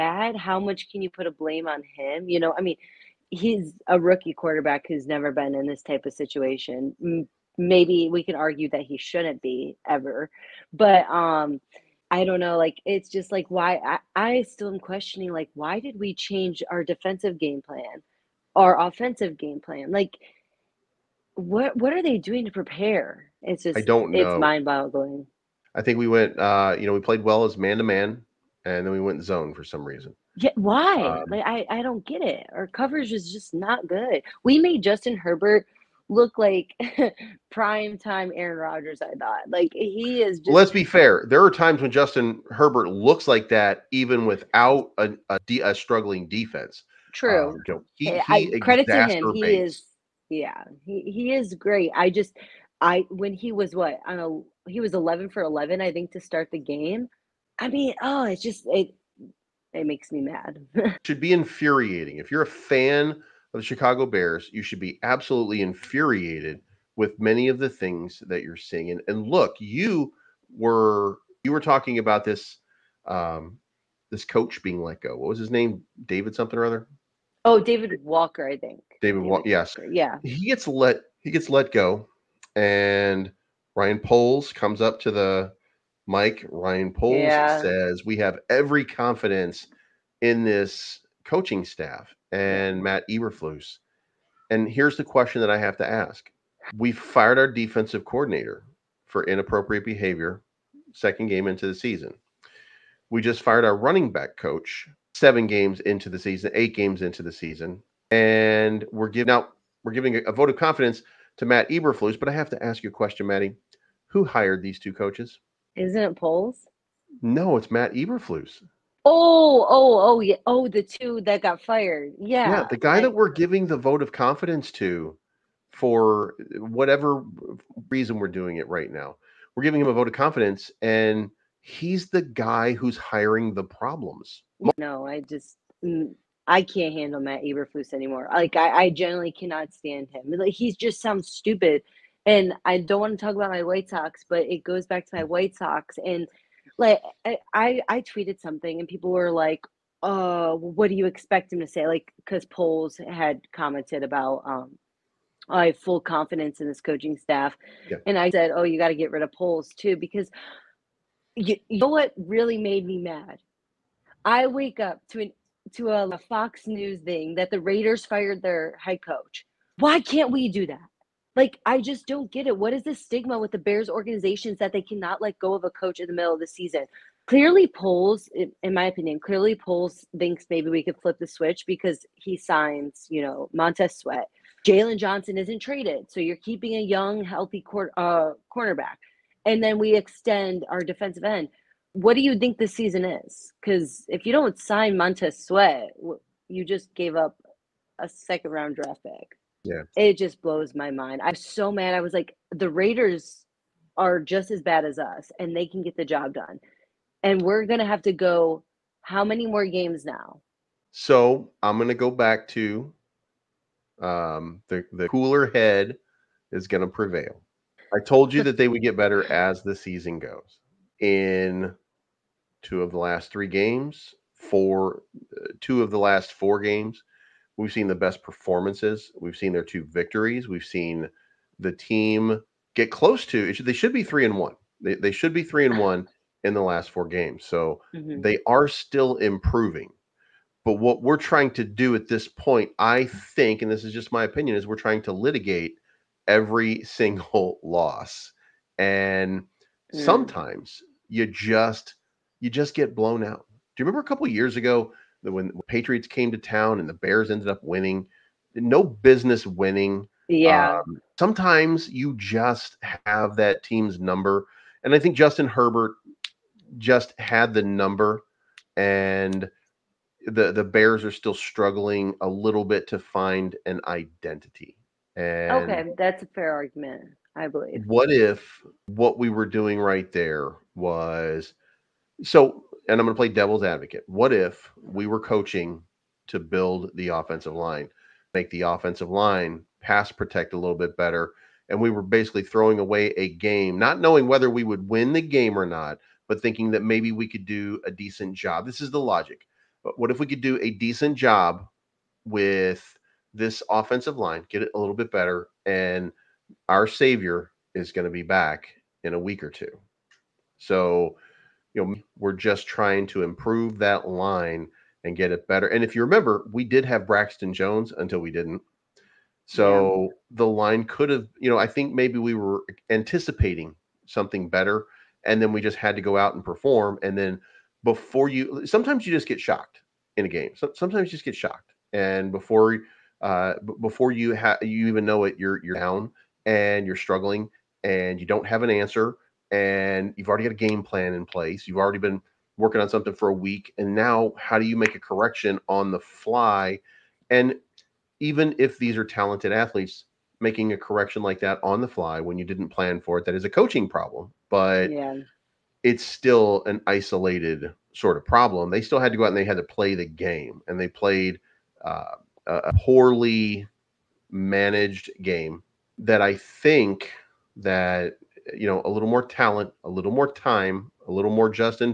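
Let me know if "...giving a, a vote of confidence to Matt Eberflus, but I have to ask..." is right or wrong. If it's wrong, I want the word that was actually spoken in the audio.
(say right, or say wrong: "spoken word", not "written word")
right.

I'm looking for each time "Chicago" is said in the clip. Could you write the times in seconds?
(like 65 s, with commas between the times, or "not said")
63 s.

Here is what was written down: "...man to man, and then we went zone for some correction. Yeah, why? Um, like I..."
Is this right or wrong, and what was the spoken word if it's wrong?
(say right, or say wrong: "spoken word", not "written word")
wrong: "reason", not "correction".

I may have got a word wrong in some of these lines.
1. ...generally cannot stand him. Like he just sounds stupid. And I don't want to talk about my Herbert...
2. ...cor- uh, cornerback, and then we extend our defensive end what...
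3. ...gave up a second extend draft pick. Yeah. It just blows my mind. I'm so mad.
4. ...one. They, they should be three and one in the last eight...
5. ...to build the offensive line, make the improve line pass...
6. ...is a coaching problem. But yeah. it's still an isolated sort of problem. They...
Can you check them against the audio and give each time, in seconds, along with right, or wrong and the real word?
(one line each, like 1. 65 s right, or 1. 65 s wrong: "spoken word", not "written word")
1. 138 s wrong: "White", not "Herbert"
2. 187 s right
3. 196 s wrong: "round", not "extend"
4. 234 s wrong: "four", not "eight"
5. 286 s wrong: "offensive", not "improve"
6. 353 s right.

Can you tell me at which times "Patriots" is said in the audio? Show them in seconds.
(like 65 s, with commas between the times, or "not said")
255 s.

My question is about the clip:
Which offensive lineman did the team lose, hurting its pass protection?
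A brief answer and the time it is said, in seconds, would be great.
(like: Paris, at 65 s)
Braxton Jones, at 317 s.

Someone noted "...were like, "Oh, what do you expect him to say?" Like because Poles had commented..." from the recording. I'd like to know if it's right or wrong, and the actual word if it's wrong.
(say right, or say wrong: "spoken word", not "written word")
right.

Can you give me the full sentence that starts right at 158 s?
and I said, "Oh, you got to get rid of Poles too," because you, you know what really made me mad.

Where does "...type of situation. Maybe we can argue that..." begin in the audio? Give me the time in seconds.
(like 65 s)
5 s.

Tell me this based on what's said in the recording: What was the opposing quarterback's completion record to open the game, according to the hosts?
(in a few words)
11 for 11.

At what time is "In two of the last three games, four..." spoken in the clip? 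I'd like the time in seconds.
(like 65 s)
220 s.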